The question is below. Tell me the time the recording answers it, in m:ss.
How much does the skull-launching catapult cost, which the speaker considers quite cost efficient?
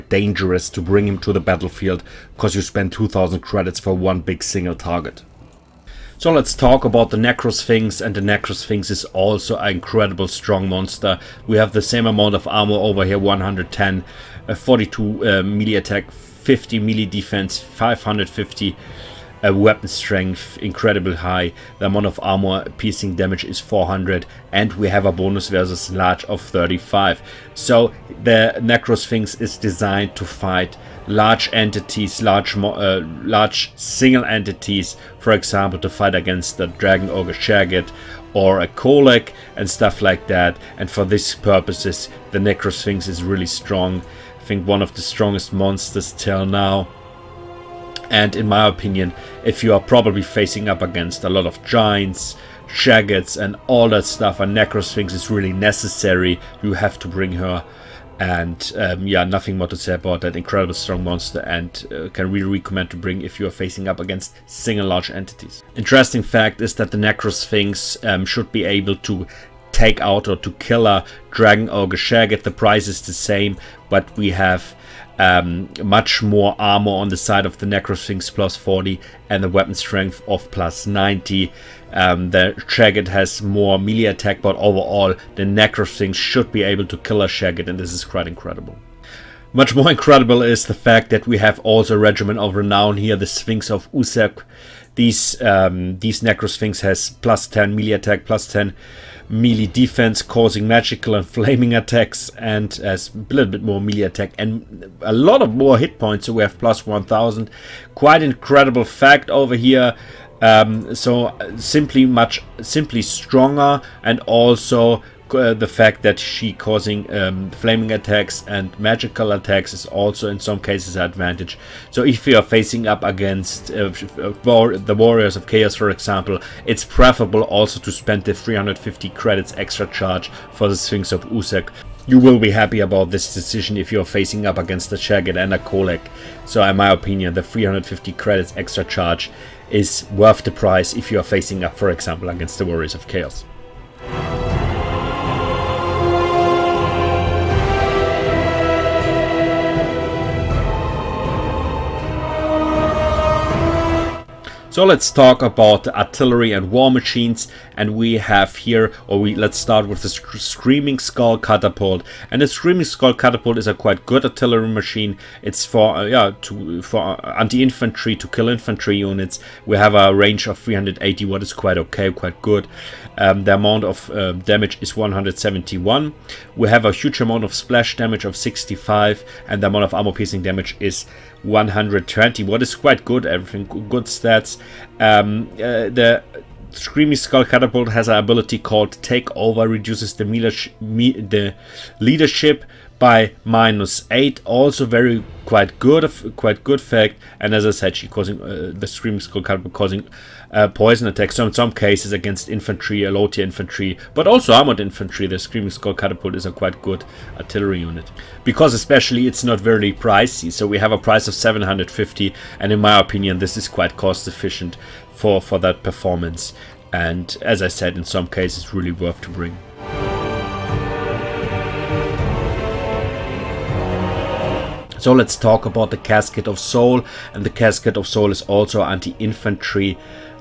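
3:31.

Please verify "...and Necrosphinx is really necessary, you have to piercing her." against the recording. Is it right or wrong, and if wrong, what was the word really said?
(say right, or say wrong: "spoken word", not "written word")
wrong: "bring", not "piercing".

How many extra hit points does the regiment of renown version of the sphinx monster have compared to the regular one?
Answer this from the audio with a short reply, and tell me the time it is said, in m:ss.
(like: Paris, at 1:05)
1000, at 1:46.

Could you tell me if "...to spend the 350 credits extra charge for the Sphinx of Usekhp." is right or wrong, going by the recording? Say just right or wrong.
right.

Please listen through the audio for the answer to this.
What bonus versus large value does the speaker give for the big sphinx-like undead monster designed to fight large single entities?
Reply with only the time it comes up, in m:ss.
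0:26.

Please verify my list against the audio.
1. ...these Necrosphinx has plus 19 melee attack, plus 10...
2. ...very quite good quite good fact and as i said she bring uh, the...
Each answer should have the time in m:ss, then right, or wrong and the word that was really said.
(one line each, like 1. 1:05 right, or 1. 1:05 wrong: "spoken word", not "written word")
1. 1:36 wrong: "10", not "19"
2. 3:14 wrong: "causing", not "bring".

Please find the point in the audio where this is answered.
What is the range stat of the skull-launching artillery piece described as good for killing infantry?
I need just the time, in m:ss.
2:50.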